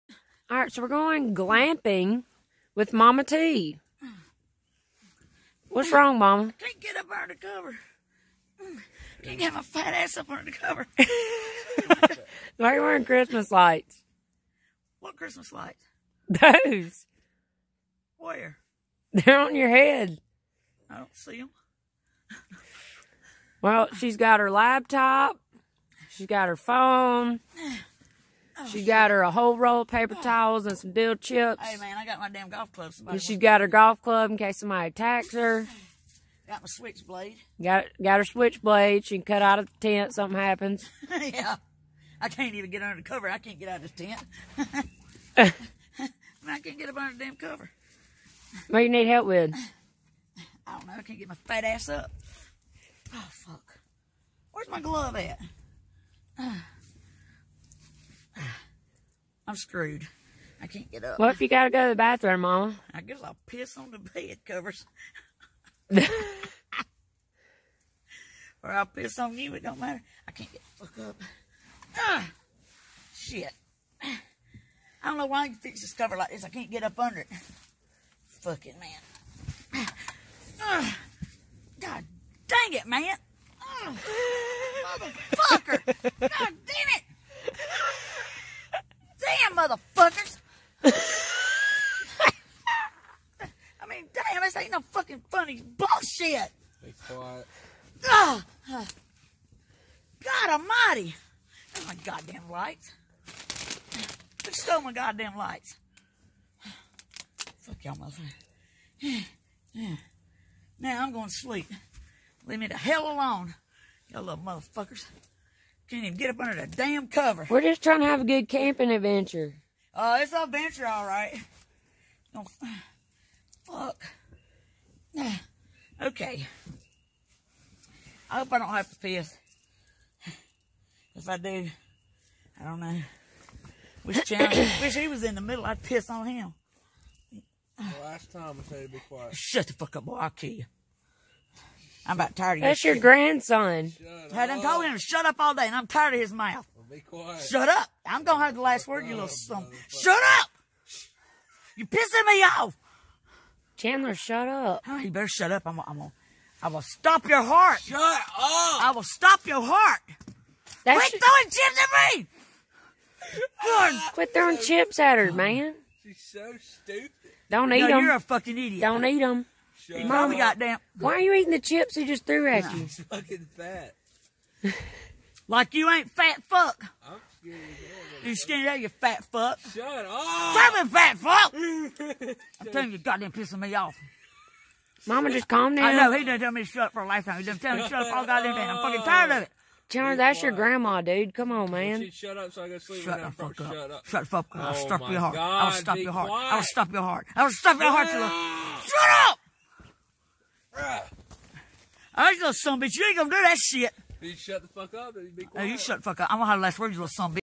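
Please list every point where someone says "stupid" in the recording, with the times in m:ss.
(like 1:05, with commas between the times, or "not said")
2:46.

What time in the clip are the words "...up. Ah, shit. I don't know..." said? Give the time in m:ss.
1:11.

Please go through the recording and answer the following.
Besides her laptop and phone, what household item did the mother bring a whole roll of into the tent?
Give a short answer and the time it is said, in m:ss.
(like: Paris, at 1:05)
Paper towels, at 0:29.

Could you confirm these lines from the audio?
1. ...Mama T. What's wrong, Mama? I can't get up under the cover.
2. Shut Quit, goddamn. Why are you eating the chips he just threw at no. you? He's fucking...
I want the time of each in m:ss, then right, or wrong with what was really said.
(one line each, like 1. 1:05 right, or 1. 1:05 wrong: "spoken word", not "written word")
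1. 0:02 right
2. 2:49 wrong: "Mama", not "Quit".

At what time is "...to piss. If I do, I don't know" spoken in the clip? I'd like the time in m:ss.
2:08.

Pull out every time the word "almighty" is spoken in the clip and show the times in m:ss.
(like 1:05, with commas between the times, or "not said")
1:40.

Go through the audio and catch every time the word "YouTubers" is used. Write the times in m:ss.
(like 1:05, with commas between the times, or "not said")
not said.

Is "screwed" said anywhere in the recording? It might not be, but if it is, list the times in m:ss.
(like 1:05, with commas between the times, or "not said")
0:59.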